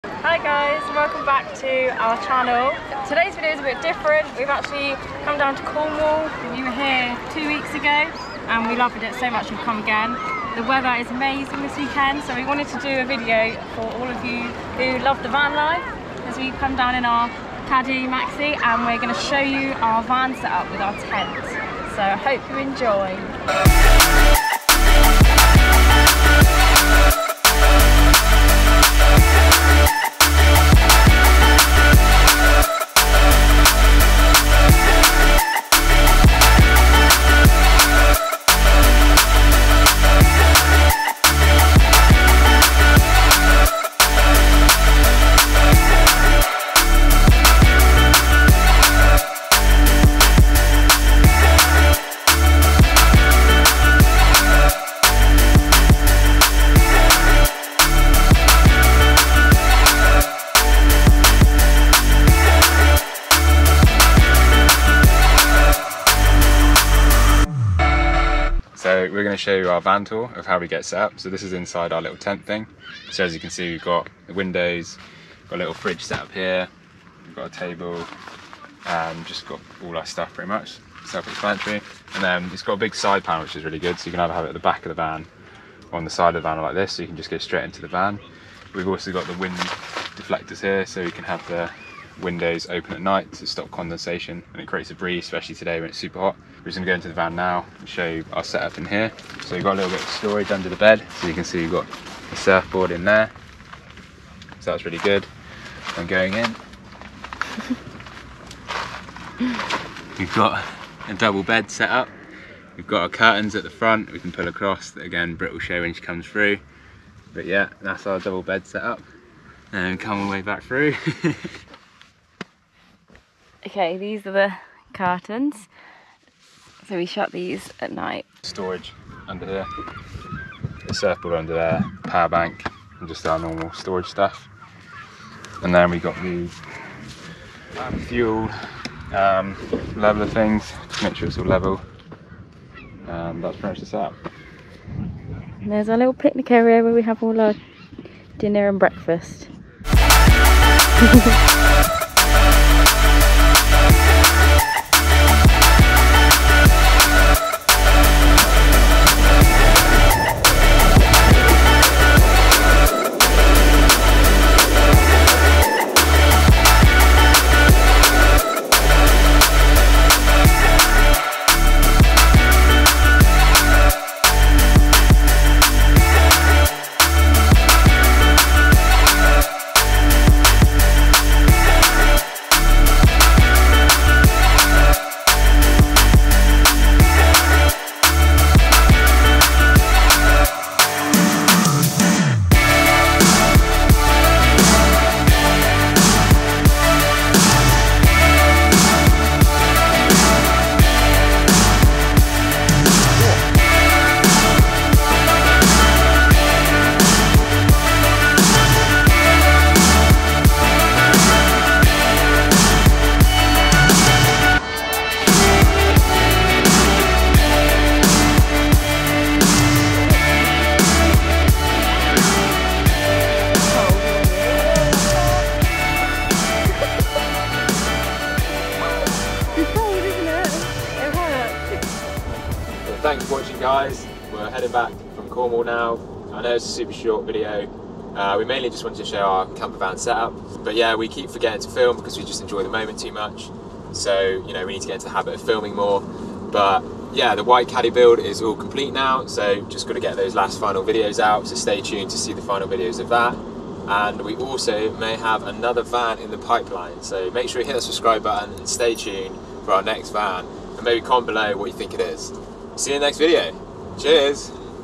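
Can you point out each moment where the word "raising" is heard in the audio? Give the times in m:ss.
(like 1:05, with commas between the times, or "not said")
not said.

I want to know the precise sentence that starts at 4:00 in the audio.
But yeah, we keep forgetting to film because we just enjoy the moment too much.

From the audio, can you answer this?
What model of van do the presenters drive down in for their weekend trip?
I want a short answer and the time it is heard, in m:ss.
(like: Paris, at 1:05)
Caddy Maxi, at 0:17.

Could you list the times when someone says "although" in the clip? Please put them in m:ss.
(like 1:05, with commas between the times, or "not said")
not said.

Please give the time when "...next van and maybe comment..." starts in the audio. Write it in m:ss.
4:19.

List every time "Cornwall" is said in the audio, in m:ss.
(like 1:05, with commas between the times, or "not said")
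0:05, 3:55.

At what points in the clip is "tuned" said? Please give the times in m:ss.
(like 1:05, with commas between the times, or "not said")
4:11, 4:18.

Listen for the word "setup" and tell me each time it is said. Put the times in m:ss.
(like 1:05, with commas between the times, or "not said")
0:20, 1:38, 2:23, 3:59.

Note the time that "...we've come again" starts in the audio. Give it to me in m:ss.
0:09.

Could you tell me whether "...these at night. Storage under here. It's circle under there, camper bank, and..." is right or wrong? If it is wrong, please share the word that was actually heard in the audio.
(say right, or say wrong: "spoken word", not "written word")
wrong: "power", not "camper".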